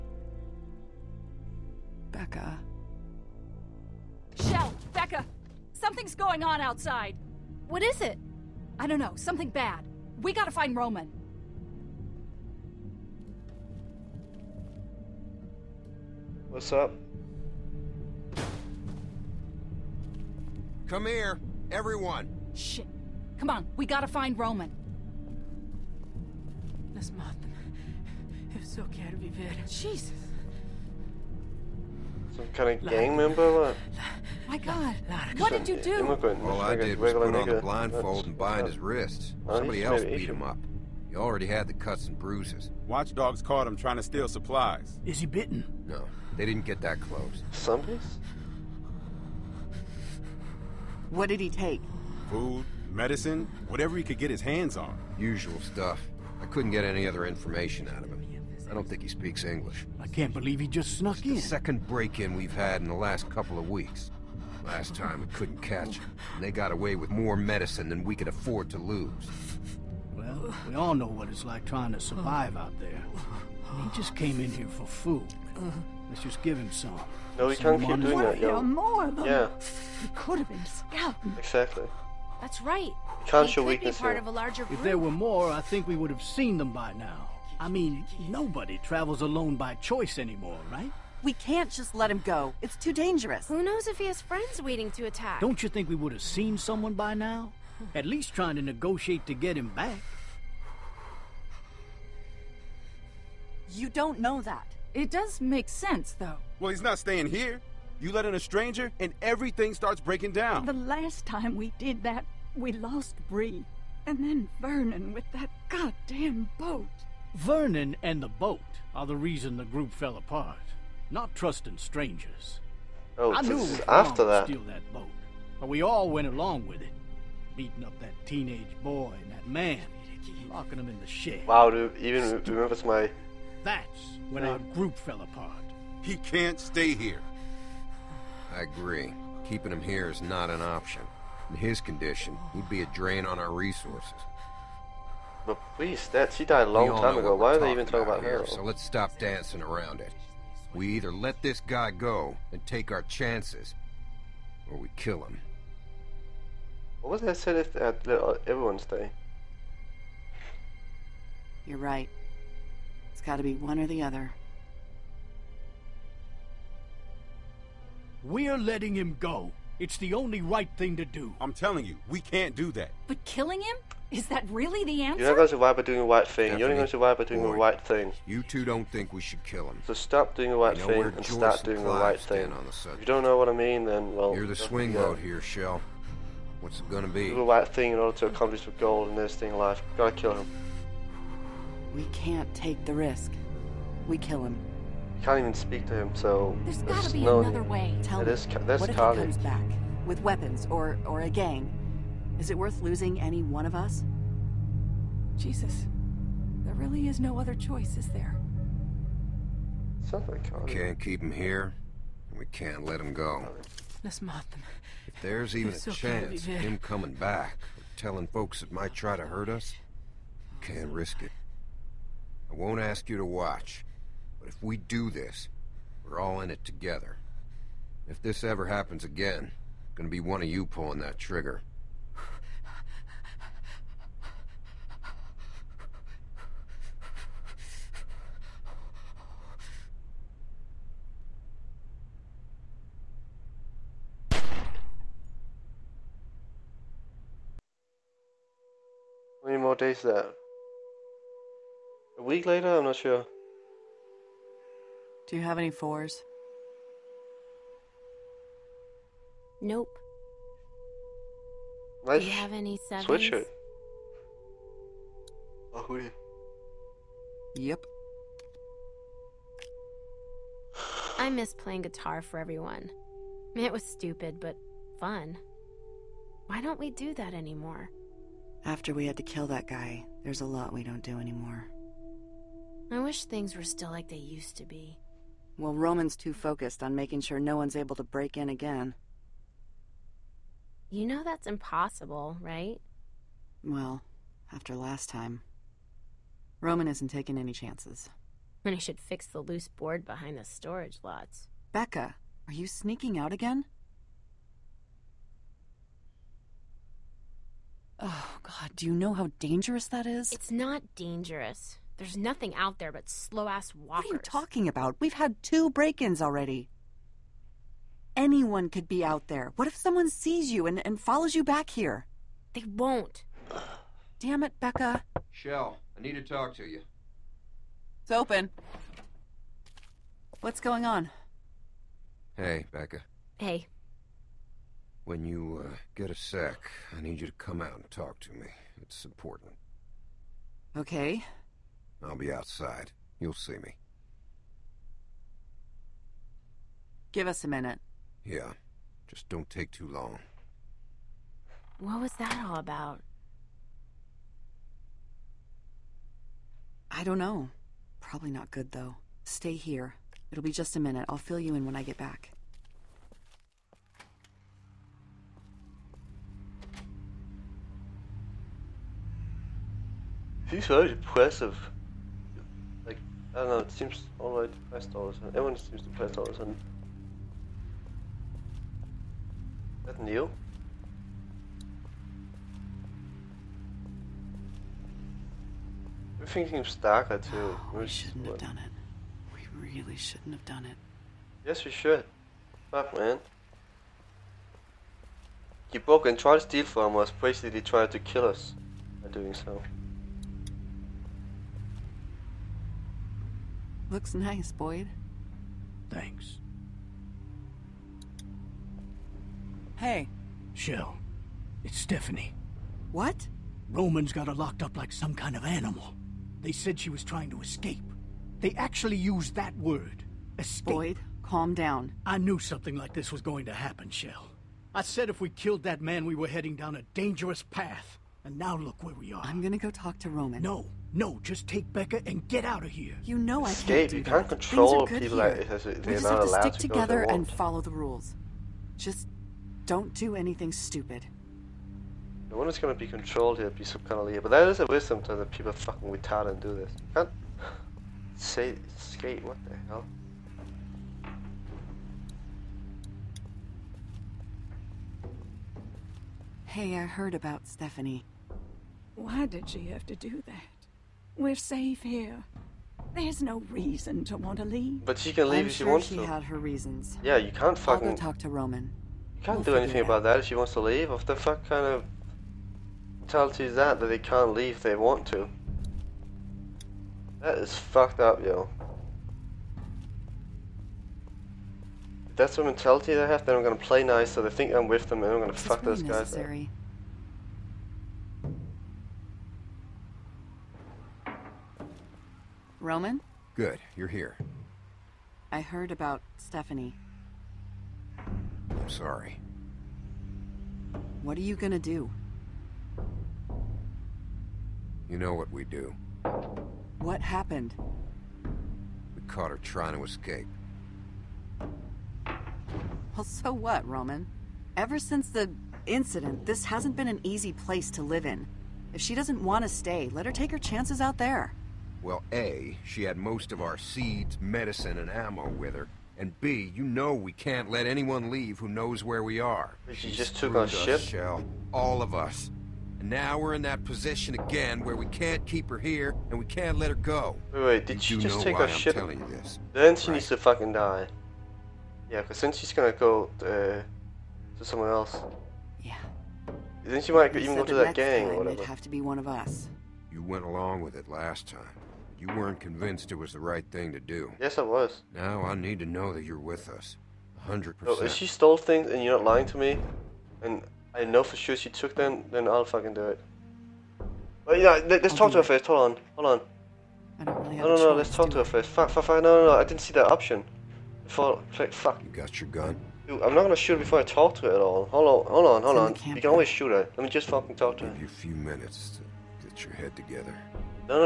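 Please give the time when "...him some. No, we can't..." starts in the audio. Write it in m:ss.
1:16.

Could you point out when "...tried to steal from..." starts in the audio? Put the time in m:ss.
6:36.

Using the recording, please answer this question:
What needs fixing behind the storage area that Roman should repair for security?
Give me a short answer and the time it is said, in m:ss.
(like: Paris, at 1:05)
loose board, at 4:59.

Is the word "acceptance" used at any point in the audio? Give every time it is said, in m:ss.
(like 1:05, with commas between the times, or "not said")
not said.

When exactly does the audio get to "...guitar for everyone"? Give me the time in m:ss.
4:31.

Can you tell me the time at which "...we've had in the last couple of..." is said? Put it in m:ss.
1:02.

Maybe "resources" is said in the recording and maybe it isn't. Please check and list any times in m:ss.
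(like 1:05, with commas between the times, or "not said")
2:23.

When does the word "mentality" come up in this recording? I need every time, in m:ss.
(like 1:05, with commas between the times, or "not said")
7:53, 8:02.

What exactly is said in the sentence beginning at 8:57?
Wait, wait, did you she just take our I'm ship?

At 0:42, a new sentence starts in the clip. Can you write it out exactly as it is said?
Watchdogs caught him trying to steal supplies.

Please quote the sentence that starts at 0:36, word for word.
All I did was put on the blindfold and bind his wrists.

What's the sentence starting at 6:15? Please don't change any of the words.
Everyone seems to price all of a sudden.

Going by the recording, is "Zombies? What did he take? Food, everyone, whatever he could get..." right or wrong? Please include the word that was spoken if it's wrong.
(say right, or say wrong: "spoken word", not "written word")
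wrong: "medicine", not "everyone".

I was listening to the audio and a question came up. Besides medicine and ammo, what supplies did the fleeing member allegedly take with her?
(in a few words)
seeds.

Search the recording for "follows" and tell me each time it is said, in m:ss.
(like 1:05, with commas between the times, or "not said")
5:21, 7:17.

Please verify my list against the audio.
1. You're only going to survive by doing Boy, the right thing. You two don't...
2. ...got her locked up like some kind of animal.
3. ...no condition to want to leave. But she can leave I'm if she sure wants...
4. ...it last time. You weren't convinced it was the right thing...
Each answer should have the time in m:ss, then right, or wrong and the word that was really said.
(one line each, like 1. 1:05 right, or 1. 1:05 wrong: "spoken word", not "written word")
1. 2:56 right
2. 6:54 right
3. 7:43 wrong: "reason", not "condition"
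4. 9:10 right.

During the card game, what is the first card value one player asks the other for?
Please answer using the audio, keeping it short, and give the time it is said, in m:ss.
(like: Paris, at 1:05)
fours, at 4:15.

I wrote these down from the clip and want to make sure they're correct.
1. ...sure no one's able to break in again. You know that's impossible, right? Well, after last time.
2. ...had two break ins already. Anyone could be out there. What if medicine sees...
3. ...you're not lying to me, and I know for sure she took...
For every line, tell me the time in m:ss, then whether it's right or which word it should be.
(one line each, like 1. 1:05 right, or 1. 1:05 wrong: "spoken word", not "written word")
1. 4:47 right
2. 5:15 wrong: "someone", not "medicine"
3. 9:18 right.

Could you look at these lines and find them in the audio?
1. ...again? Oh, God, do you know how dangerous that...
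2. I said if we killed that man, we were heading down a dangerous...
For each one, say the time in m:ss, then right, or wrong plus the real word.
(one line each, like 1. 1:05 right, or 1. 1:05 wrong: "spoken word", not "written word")
1. 5:03 right
2. 7:04 right.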